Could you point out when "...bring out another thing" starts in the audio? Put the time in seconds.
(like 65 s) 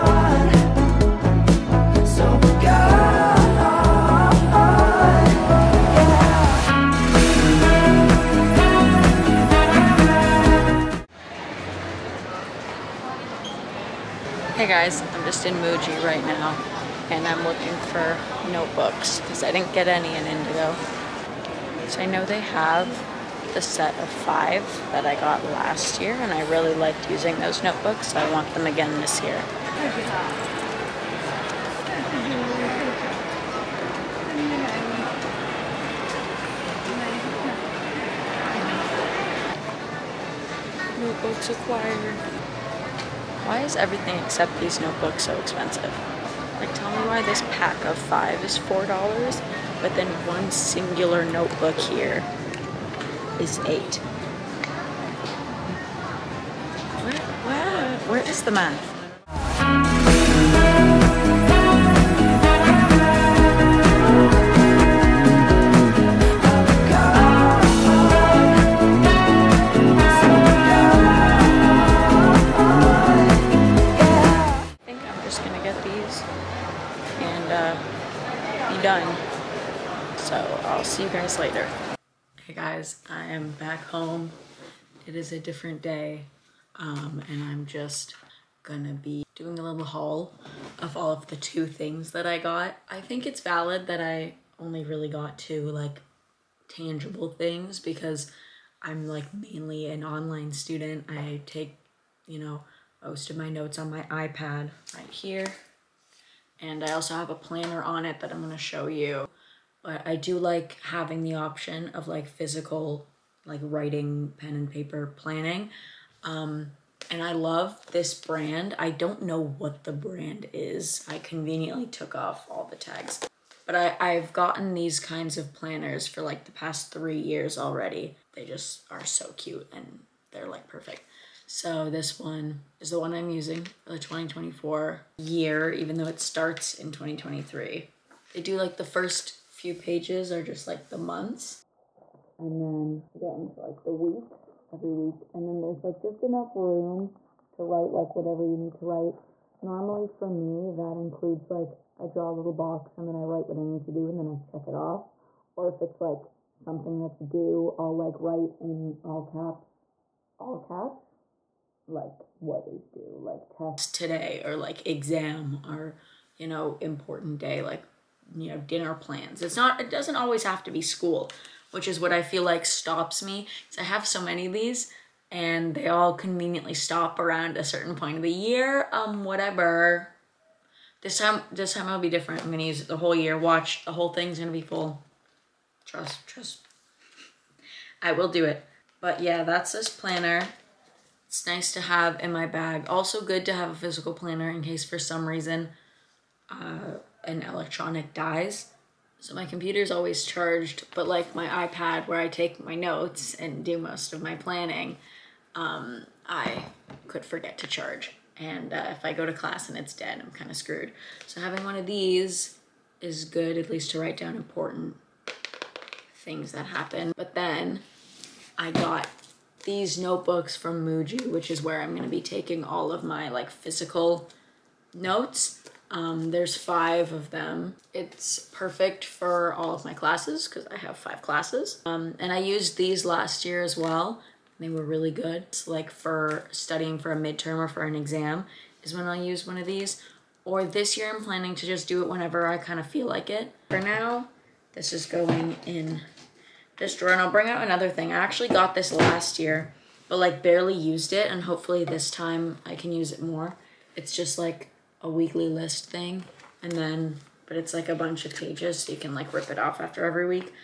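247 s.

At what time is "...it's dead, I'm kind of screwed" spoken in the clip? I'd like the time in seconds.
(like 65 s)
209 s.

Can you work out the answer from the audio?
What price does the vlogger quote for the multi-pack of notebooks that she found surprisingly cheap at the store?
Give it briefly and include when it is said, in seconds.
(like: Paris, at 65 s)
$4, at 48 s.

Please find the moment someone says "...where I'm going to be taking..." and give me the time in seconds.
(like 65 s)
221 s.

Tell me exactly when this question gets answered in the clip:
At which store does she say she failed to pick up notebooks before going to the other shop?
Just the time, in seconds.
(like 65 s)
20 s.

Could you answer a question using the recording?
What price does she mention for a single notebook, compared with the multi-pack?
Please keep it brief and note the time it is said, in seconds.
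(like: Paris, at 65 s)
$8, at 53 s.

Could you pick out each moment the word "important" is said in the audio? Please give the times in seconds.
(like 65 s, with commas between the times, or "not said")
166 s, 214 s.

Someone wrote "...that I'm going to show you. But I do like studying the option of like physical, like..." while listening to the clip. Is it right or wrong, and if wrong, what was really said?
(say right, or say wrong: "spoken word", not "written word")
wrong: "having", not "studying".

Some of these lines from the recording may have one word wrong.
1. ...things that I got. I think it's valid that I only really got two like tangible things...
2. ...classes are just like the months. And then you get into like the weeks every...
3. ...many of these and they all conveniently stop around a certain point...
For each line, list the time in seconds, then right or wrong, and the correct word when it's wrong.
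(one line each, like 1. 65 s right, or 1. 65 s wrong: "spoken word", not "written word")
1. 91 s right
2. 139 s wrong: "pages", not "classes"
3. 174 s right.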